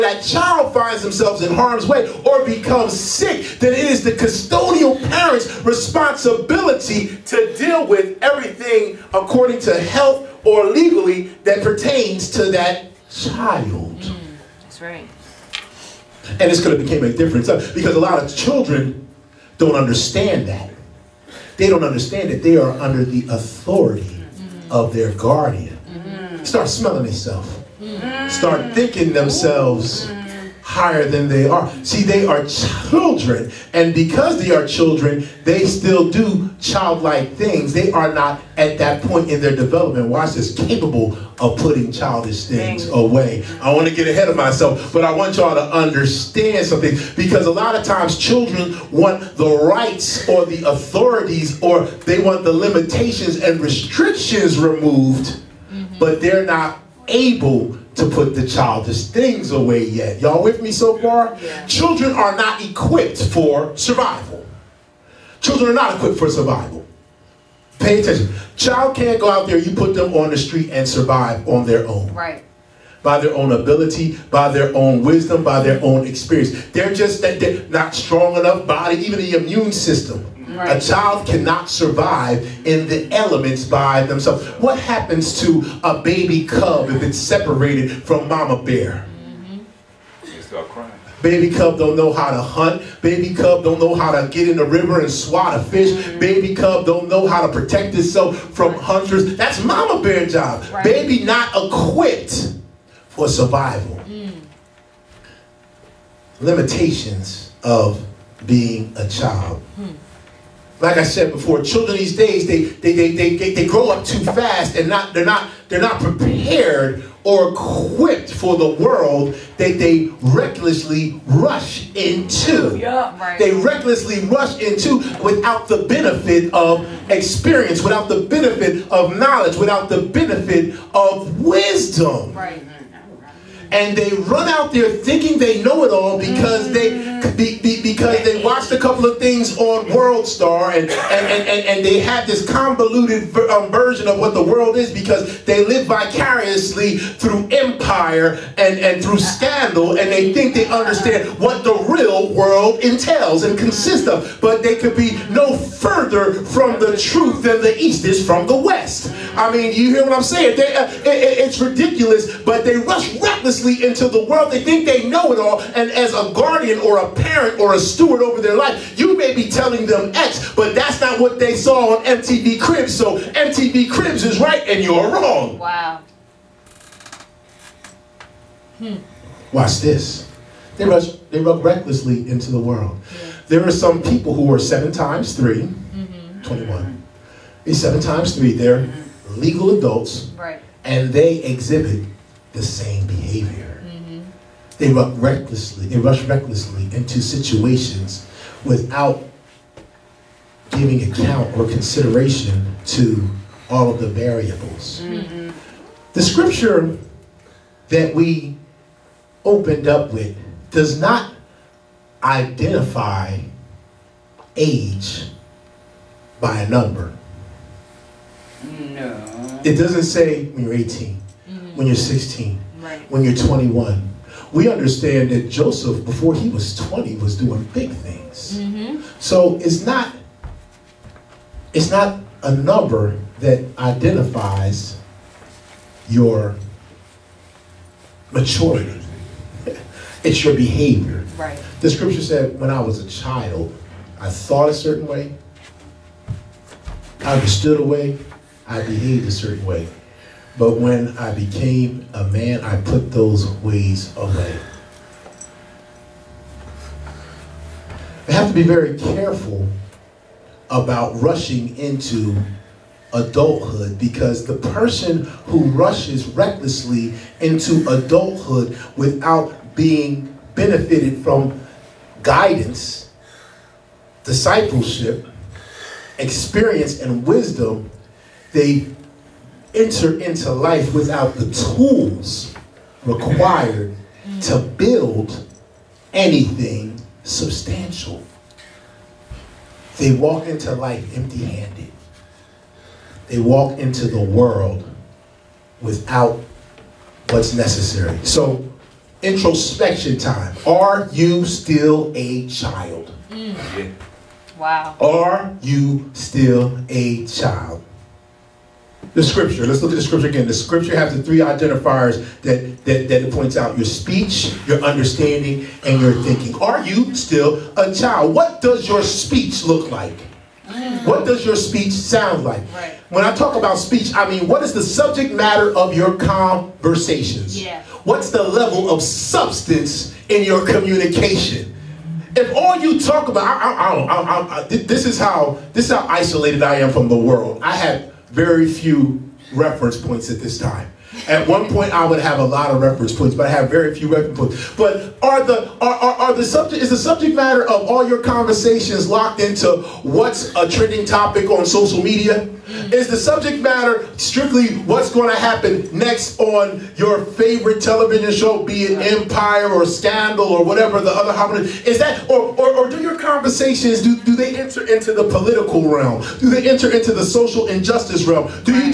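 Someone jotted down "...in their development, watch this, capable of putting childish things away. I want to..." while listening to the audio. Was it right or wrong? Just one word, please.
right.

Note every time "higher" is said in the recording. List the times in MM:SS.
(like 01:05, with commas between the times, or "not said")
00:30.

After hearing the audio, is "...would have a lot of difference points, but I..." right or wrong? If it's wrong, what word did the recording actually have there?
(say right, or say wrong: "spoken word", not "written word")
wrong: "reference", not "difference".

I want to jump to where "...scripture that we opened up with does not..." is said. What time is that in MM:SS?
03:26.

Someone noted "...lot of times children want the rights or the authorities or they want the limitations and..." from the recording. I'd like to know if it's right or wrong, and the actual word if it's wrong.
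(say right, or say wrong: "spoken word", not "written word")
right.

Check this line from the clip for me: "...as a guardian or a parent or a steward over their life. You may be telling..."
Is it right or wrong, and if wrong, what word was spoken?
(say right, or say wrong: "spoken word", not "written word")
right.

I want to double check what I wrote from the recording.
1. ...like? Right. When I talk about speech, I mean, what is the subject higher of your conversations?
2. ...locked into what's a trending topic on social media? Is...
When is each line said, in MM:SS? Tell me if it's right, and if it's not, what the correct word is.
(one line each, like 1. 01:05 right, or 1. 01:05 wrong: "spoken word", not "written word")
1. 05:22 wrong: "matter", not "higher"
2. 05:49 right.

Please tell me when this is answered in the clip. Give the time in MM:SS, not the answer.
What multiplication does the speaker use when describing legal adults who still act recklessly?
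03:04.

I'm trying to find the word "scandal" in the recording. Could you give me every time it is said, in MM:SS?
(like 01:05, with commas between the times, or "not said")
02:29, 05:59.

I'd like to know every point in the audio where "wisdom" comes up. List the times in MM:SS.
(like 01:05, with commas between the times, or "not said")
01:15, 02:11, 04:37.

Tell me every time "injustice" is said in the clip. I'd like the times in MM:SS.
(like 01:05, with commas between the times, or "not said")
06:07.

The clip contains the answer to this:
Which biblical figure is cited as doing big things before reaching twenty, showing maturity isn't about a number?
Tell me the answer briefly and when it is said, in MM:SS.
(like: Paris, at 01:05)
Joseph, at 03:45.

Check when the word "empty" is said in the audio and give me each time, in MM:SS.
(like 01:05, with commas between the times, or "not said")
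04:51.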